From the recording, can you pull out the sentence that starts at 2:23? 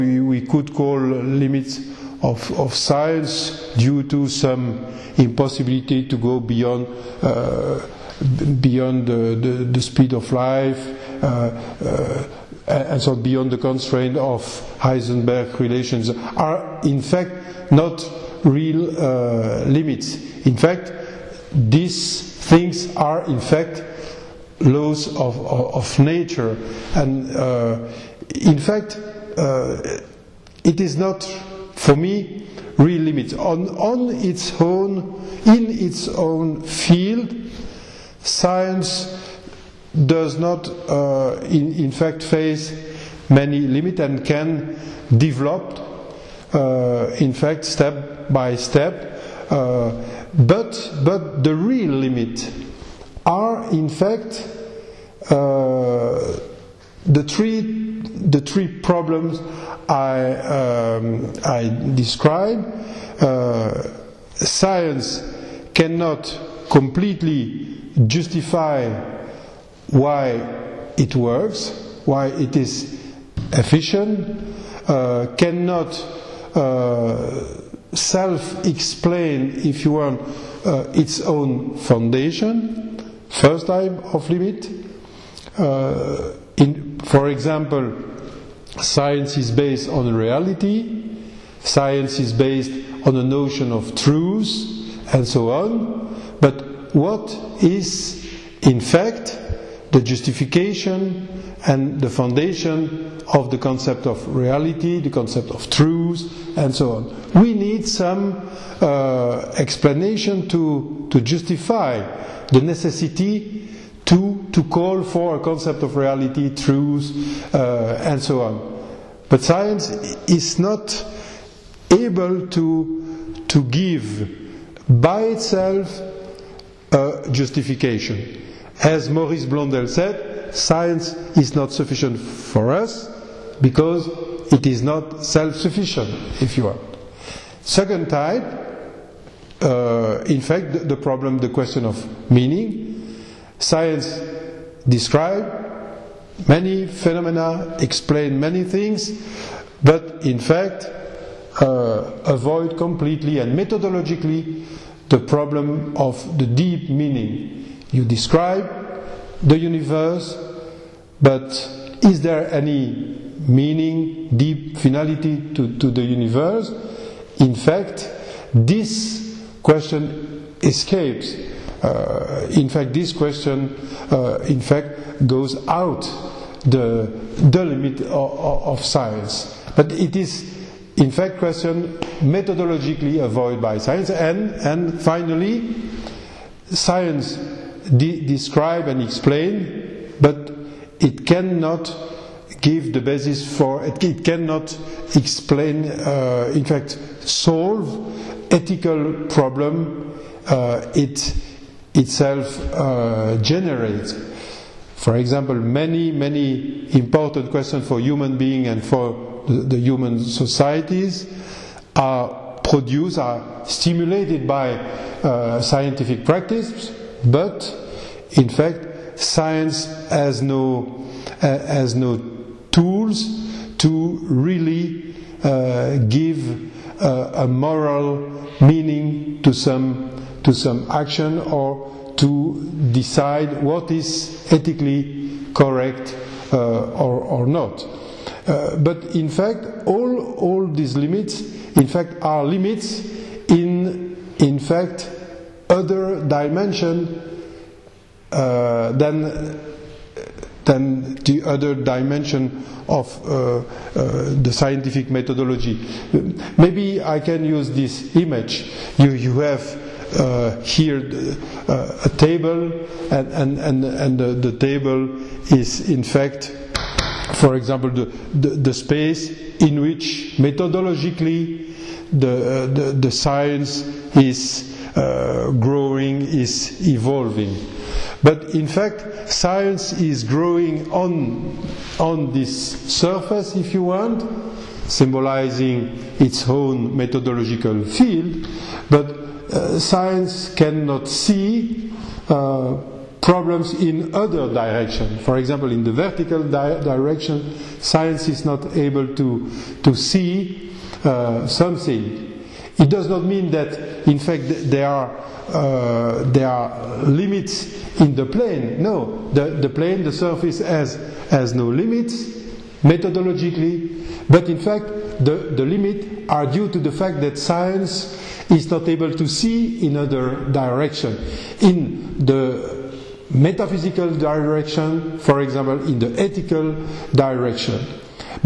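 Science describe many phenomena, explain many things, but in fact uh, avoid completely and methodologically the problem of the deep meaning.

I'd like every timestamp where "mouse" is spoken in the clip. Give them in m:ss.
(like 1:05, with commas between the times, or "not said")
not said.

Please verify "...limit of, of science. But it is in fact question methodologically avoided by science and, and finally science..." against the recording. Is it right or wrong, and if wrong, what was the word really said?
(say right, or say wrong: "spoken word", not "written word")
right.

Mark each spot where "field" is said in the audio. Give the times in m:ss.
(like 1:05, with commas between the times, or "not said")
0:36, 4:47.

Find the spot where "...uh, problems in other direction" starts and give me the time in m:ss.
4:52.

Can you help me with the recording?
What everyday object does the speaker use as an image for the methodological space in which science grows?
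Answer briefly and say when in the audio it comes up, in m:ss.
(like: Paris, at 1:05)
A table, at 4:22.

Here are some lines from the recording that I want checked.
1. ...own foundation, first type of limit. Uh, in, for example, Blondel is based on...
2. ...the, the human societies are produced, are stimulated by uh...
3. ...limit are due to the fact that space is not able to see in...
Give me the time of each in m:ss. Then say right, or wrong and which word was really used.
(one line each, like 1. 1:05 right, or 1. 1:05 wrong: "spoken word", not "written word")
1. 1:21 wrong: "Science", not "Blondel"
2. 3:29 right
3. 5:15 wrong: "science", not "space".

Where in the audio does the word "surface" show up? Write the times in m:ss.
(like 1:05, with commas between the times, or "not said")
4:42, 5:10.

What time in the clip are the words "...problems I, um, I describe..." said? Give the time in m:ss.
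0:58.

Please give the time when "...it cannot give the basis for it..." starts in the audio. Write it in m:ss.
3:10.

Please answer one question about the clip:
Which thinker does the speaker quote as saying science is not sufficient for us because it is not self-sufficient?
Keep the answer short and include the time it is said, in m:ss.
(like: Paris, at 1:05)
Maurice Blondel, at 2:09.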